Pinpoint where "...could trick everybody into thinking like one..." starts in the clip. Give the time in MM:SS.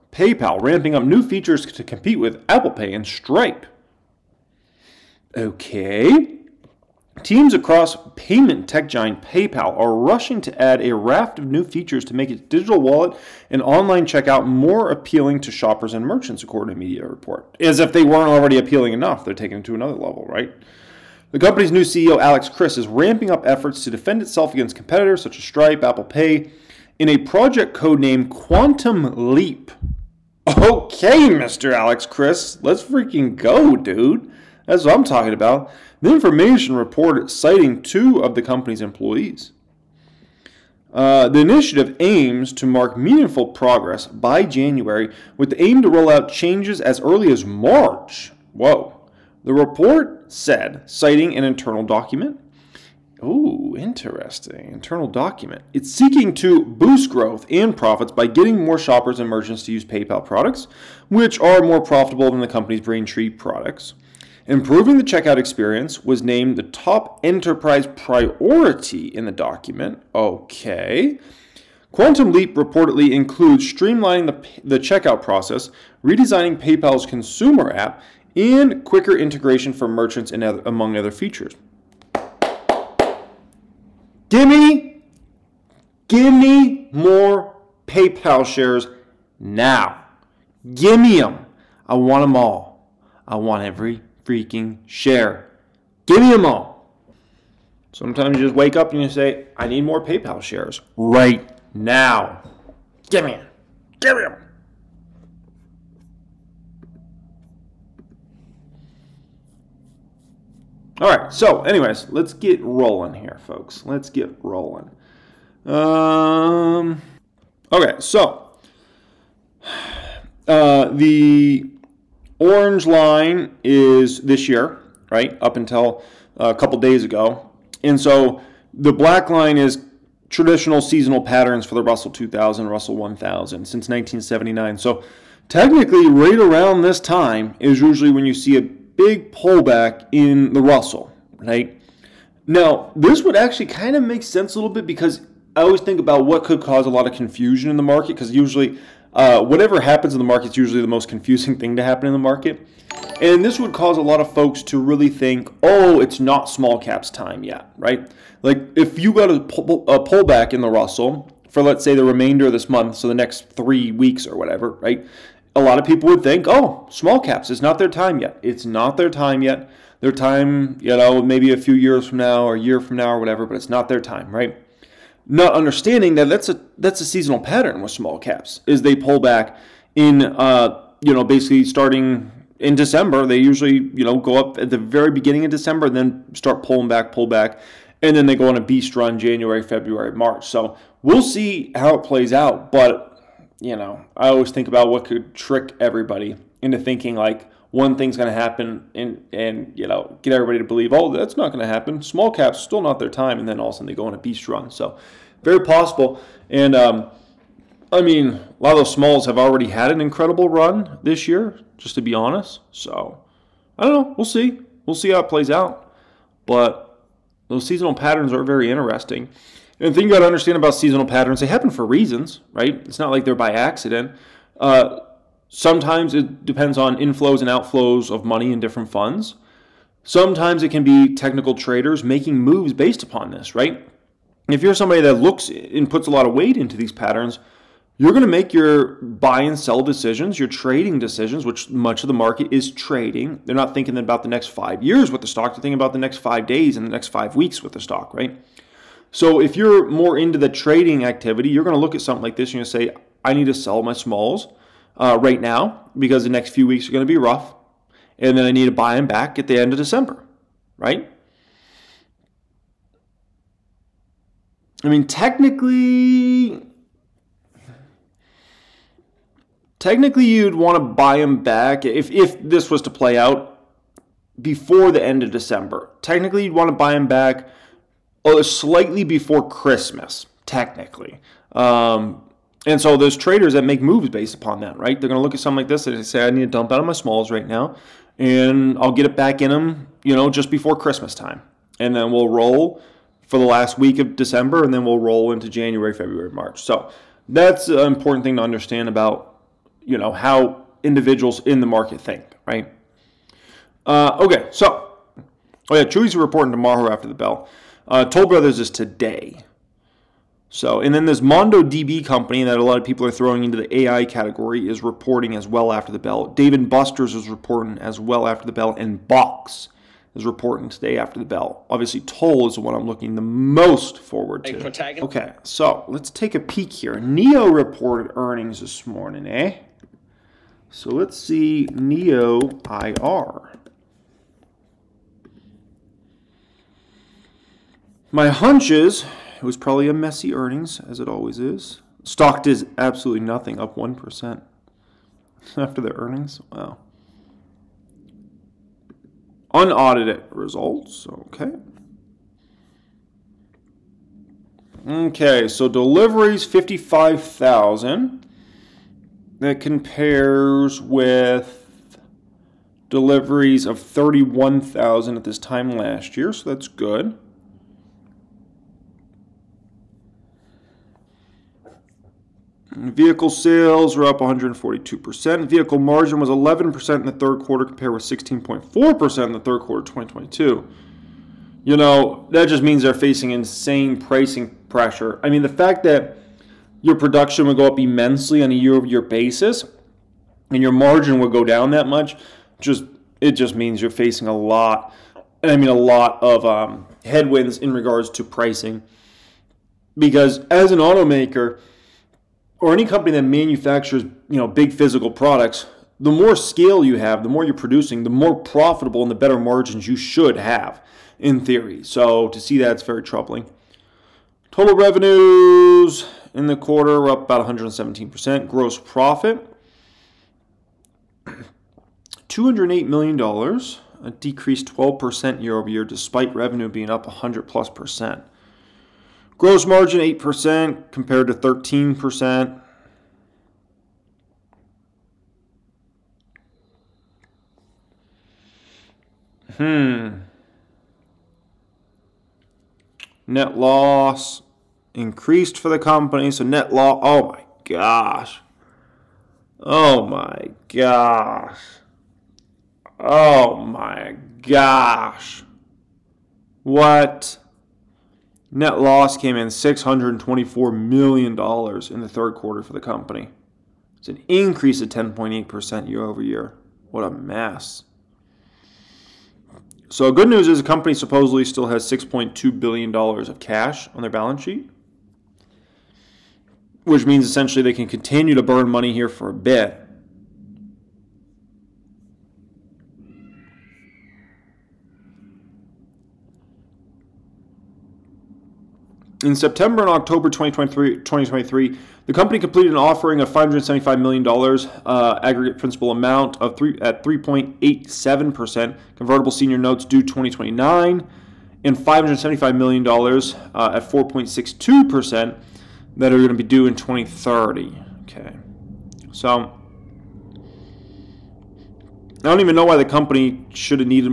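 03:15.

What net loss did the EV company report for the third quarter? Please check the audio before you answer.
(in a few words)
$624 million.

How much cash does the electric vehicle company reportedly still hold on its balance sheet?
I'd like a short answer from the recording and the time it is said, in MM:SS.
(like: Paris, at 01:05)
$6.2 billion, at 07:51.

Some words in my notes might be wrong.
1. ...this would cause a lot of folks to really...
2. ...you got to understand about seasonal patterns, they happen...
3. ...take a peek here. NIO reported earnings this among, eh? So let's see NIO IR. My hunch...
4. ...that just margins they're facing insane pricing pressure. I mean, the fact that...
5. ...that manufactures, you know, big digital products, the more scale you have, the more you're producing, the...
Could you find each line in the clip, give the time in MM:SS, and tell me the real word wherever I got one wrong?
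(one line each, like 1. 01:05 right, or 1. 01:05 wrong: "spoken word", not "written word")
1. 02:33 right
2. 03:40 right
3. 05:26 wrong: "morning", not "among"
4. 06:22 wrong: "means", not "margins"
5. 06:43 wrong: "physical", not "digital".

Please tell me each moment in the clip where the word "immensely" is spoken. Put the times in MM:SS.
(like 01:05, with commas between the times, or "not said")
06:27.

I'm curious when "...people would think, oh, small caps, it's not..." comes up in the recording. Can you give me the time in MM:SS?
02:45.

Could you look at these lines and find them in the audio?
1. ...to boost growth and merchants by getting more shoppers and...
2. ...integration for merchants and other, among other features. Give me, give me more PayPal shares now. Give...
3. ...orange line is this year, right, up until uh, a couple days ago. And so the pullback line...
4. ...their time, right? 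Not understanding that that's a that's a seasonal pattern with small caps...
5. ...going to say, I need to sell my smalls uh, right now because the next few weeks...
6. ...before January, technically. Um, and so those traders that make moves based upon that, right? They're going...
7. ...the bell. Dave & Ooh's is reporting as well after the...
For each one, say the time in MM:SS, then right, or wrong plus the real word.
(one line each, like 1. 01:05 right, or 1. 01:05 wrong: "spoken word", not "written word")
1. 00:56 wrong: "profits", not "merchants"
2. 01:19 right
3. 02:02 wrong: "black", not "pullback"
4. 02:53 right
5. 04:12 right
6. 04:39 wrong: "Christmas", not "January"
7. 05:15 wrong: "Buster", not "Ooh".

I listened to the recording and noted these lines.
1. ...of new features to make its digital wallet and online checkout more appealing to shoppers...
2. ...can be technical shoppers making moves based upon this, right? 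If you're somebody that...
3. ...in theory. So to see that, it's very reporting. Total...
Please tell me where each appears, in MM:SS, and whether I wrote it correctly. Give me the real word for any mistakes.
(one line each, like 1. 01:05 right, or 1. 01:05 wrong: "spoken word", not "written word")
1. 00:11 right
2. 03:50 wrong: "traders", not "shoppers"
3. 06:51 wrong: "troubling", not "reporting".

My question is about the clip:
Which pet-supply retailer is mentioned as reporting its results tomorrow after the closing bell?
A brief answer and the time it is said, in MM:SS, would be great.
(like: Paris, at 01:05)
Chewy, at 05:05.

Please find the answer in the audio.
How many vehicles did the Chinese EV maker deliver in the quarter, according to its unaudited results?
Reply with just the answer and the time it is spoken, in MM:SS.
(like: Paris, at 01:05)
55,000, at 05:56.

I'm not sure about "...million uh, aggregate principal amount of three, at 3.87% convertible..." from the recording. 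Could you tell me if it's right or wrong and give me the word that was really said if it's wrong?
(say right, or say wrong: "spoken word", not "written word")
right.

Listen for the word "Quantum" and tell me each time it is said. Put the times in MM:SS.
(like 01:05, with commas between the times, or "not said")
00:28, 01:11.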